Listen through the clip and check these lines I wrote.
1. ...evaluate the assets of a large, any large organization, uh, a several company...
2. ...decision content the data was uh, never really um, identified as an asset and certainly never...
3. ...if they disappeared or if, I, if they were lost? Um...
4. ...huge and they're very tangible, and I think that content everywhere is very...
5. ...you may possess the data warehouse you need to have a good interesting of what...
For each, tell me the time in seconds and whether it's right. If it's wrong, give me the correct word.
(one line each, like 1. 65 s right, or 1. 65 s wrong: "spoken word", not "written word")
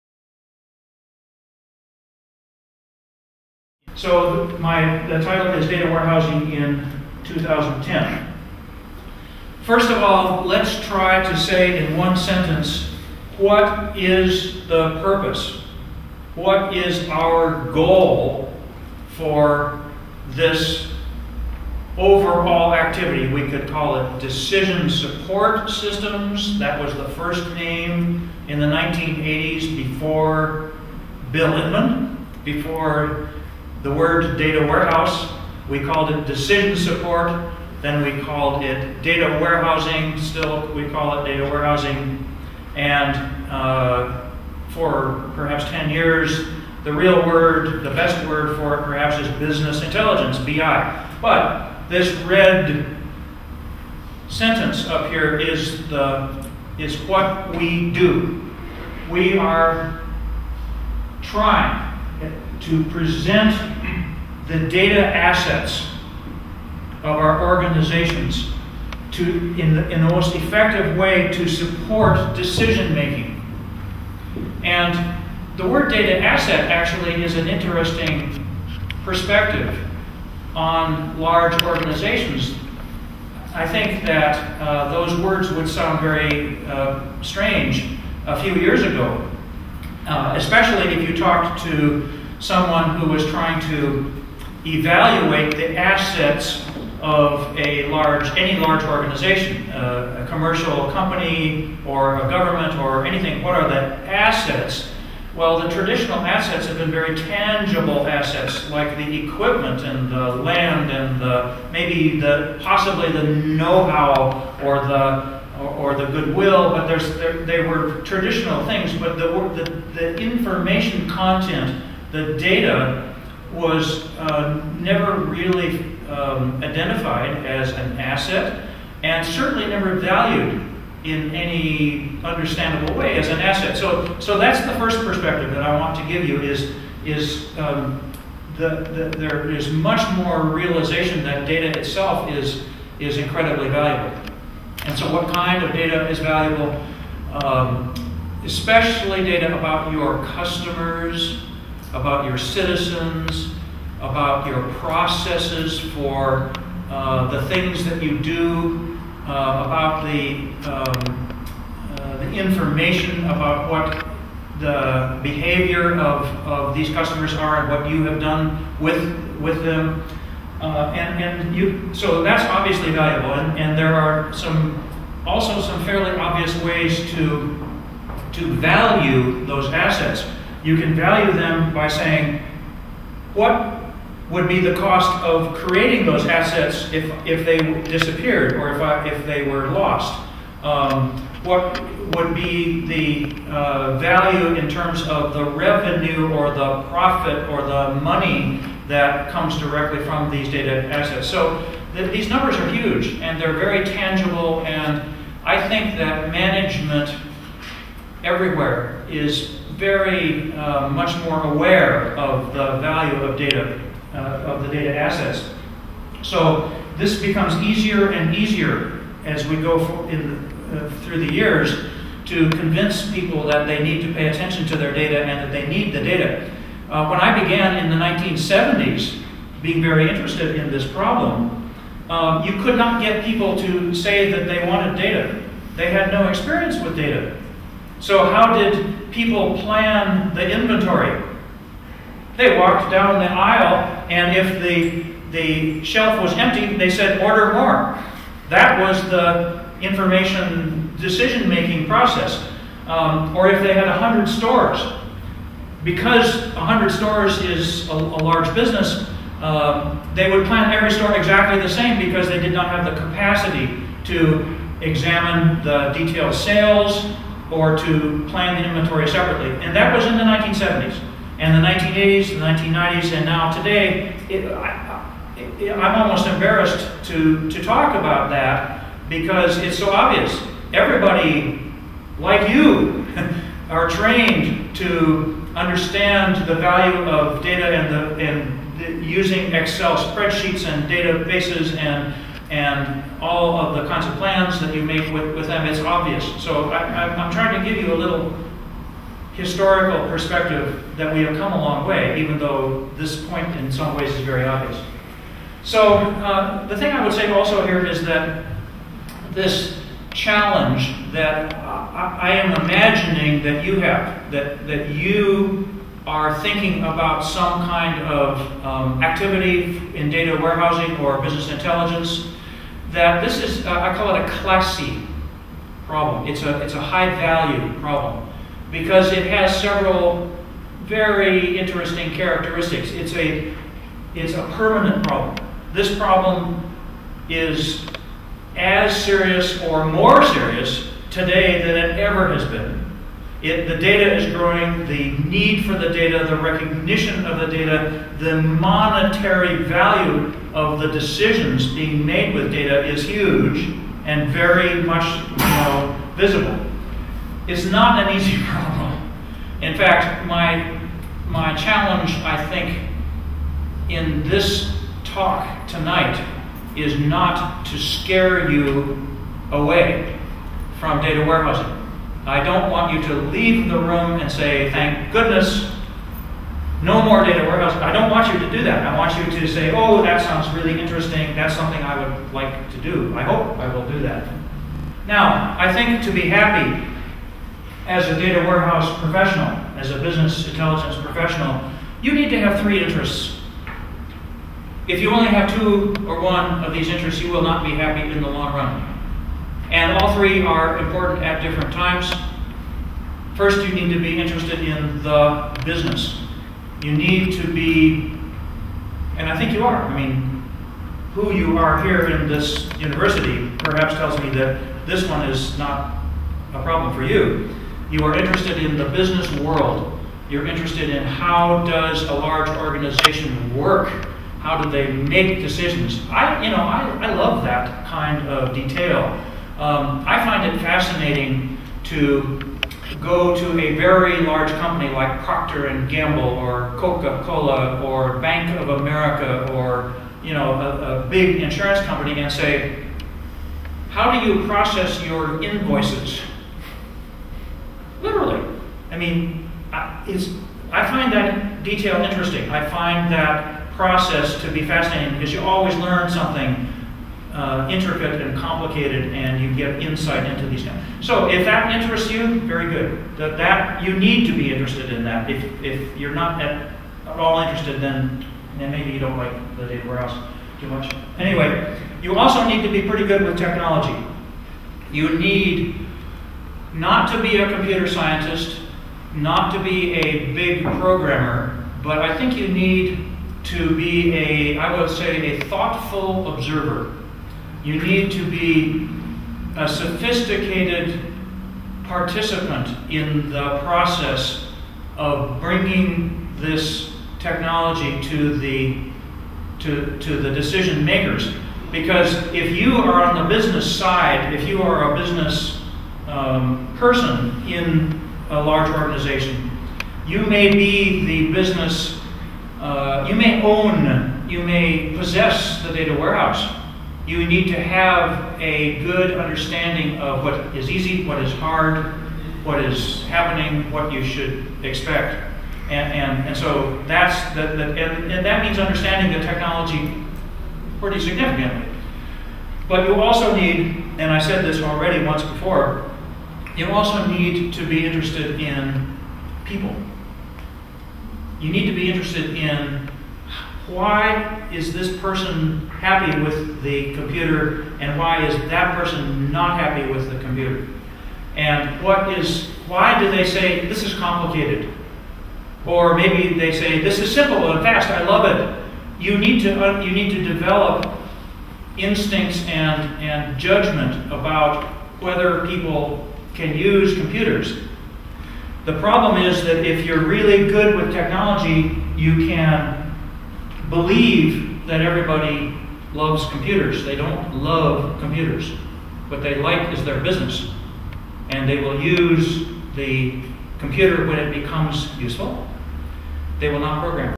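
1. 94 s wrong: "commercial", not "several"
2. 120 s wrong: "information", not "decision"
3. 187 s right
4. 202 s wrong: "management", not "content"
5. 514 s wrong: "understanding", not "interesting".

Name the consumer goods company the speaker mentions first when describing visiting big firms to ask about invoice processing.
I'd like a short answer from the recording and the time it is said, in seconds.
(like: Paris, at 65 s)
Procter and Gamble, at 435 s.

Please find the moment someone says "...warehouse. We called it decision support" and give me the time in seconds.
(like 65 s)
34 s.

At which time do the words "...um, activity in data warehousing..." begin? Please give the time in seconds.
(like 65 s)
318 s.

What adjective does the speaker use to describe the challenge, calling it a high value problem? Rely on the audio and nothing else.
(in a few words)
classy.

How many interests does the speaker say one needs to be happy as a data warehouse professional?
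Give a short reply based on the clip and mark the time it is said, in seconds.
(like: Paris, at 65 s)
3, at 392 s.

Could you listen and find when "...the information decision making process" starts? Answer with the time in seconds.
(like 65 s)
249 s.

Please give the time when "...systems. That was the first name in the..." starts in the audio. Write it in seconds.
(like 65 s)
25 s.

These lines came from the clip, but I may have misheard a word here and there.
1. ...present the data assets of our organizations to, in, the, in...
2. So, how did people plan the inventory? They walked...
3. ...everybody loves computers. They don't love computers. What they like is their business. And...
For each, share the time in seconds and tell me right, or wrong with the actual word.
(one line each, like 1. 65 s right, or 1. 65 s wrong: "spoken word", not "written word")
1. 62 s right
2. 238 s right
3. 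574 s right.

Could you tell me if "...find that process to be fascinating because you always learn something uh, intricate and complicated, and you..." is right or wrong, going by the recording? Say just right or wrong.
right.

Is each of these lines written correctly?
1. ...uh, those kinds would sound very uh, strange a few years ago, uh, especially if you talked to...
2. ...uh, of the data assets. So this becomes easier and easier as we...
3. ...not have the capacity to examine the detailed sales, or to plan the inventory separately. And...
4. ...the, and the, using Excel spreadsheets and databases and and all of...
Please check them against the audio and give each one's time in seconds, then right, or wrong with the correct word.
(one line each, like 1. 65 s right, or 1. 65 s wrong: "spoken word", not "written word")
1. 84 s wrong: "words", not "kinds"
2. 214 s right
3. 262 s right
4. 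287 s right.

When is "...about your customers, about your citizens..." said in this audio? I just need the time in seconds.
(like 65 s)
149 s.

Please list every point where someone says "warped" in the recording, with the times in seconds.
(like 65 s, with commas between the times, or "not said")
not said.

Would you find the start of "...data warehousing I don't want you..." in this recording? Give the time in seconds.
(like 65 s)
371 s.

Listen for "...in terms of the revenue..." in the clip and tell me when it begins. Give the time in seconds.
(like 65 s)
194 s.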